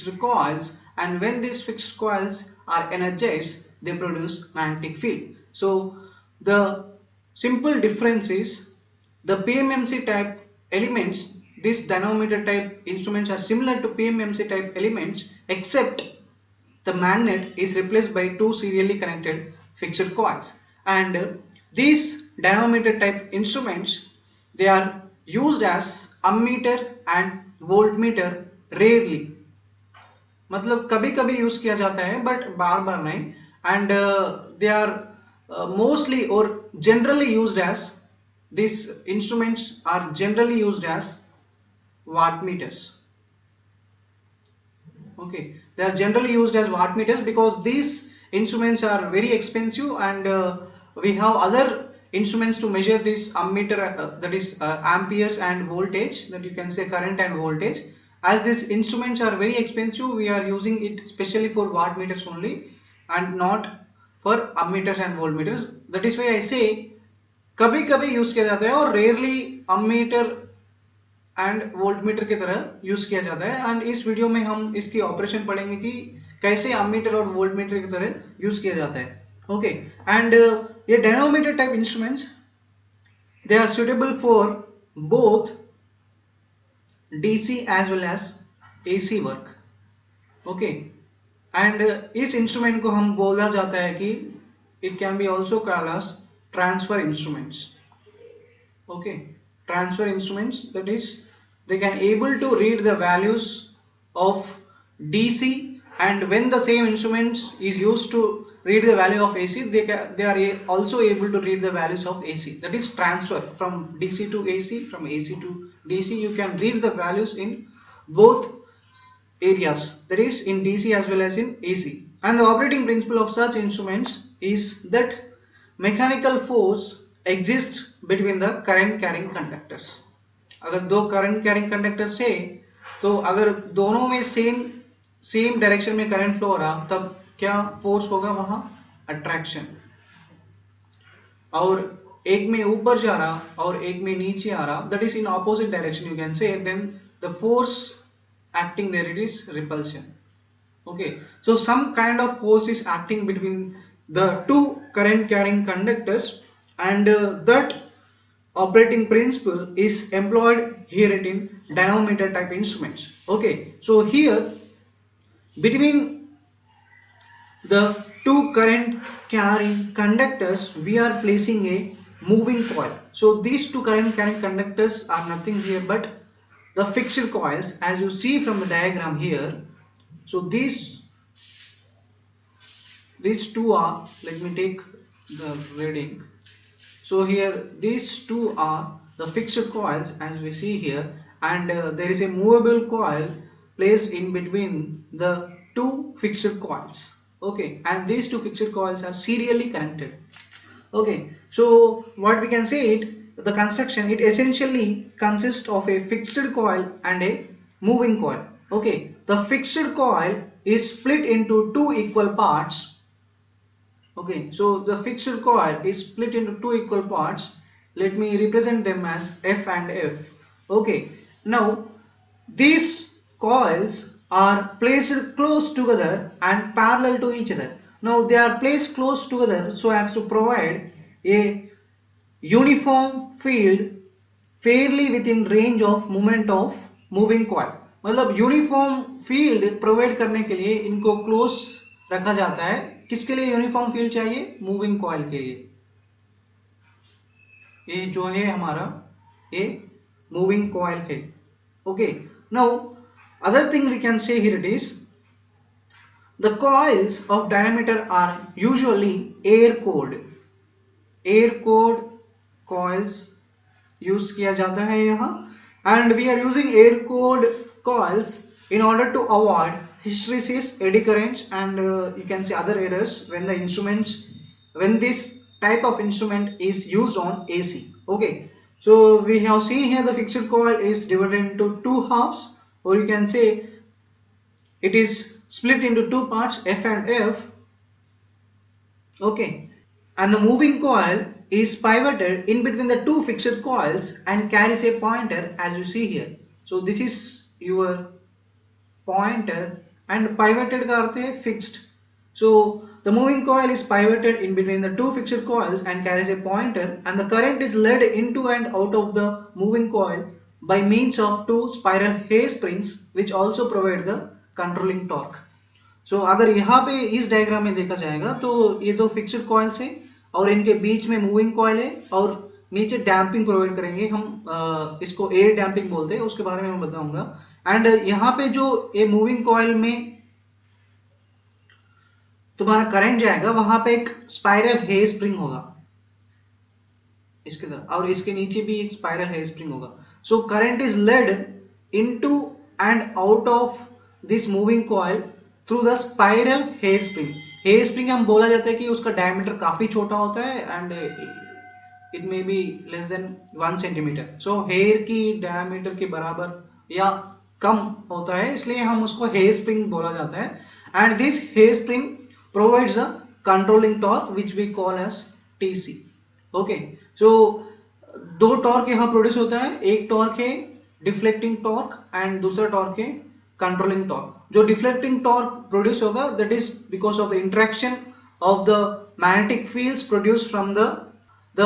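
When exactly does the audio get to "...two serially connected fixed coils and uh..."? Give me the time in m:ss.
0:18.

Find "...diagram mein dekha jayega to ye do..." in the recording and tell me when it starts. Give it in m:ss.
5:17.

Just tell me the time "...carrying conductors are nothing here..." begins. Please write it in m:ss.
2:54.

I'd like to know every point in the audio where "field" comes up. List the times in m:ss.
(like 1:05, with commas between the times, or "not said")
0:05, 6:19.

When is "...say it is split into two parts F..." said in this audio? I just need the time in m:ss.
4:43.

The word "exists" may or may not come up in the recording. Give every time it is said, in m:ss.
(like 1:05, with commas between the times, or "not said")
2:07.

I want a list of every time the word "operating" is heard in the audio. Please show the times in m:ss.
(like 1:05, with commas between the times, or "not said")
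2:02, 2:38.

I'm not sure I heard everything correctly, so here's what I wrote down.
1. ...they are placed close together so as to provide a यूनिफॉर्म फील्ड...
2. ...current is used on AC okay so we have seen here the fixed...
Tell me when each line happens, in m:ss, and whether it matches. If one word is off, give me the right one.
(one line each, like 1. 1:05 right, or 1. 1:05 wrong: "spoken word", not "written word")
1. 3:48 right
2. 4:35 wrong: "instrument", not "current".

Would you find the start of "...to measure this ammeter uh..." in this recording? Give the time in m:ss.
0:52.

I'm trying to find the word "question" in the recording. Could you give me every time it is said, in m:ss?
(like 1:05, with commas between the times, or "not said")
not said.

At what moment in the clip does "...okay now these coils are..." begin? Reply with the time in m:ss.
3:40.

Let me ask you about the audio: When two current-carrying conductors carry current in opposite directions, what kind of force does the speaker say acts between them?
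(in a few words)
Repulsion.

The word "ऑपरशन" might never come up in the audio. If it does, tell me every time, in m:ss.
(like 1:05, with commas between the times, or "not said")
1:15.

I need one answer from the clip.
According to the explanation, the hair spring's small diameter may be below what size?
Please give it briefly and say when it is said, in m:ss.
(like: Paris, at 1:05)
1 centimeter, at 5:53.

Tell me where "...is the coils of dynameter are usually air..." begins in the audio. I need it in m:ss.
4:14.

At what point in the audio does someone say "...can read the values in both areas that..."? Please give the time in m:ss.
1:56.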